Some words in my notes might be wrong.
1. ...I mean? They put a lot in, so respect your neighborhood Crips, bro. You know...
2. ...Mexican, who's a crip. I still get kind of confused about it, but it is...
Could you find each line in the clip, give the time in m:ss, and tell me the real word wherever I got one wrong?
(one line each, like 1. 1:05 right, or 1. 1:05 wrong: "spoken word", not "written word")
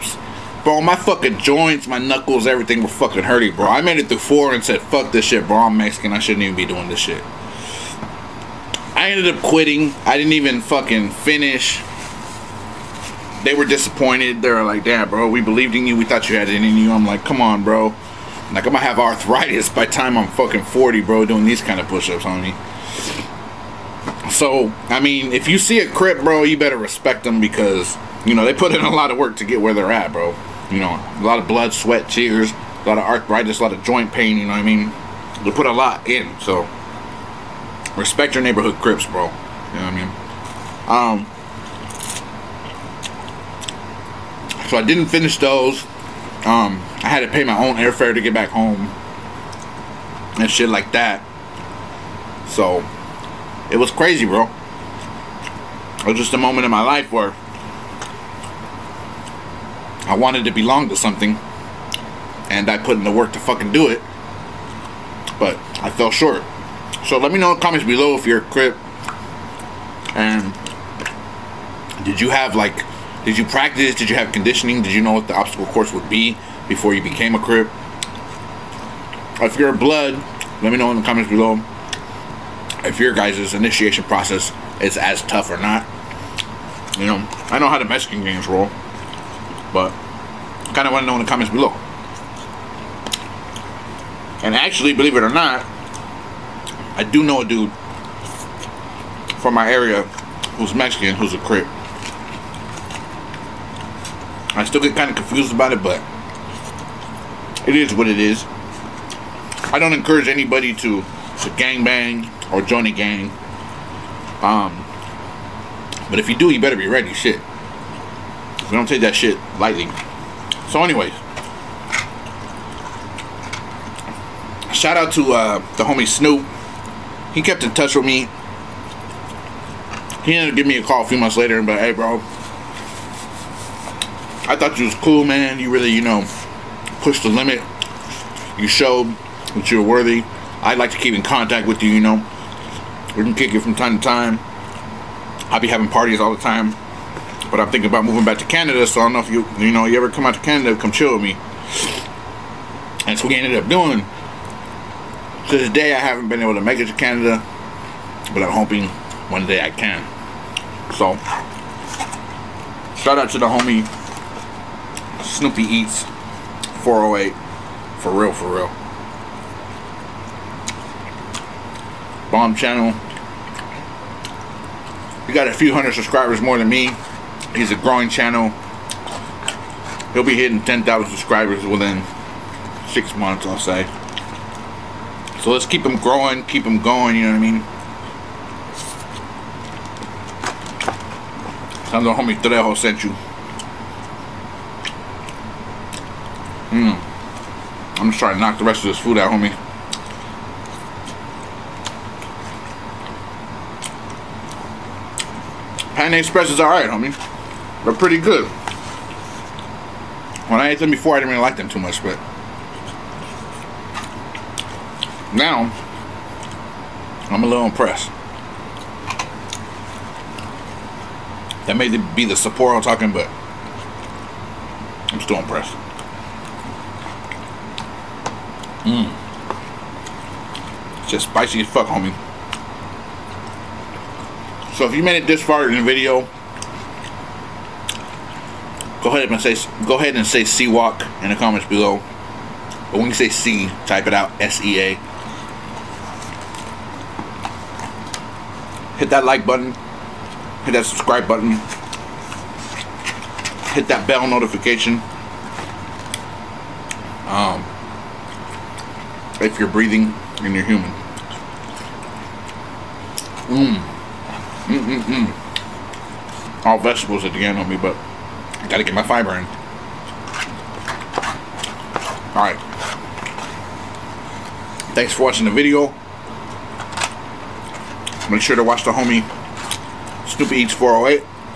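1. 0:34 right
2. 1:40 right.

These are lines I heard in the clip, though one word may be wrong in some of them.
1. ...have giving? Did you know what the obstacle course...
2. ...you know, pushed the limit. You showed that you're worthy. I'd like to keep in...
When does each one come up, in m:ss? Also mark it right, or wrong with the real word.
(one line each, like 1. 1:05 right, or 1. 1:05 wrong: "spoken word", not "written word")
1. 1:14 wrong: "conditioning", not "giving"
2. 2:15 right.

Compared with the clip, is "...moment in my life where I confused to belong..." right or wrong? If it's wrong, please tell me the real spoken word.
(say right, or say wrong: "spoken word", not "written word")
wrong: "wanted", not "confused".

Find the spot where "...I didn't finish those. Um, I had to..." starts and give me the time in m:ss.
0:44.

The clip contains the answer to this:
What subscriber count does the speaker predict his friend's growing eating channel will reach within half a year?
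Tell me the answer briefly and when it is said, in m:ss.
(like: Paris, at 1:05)
10,000, at 3:00.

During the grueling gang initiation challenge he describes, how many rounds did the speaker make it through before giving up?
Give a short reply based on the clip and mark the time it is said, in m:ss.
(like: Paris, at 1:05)
4, at 0:04.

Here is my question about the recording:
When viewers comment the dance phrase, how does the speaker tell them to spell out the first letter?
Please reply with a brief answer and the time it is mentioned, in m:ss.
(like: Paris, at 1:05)
S E A, at 4:04.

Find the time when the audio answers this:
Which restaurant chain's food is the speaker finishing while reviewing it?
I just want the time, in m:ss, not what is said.
3:25.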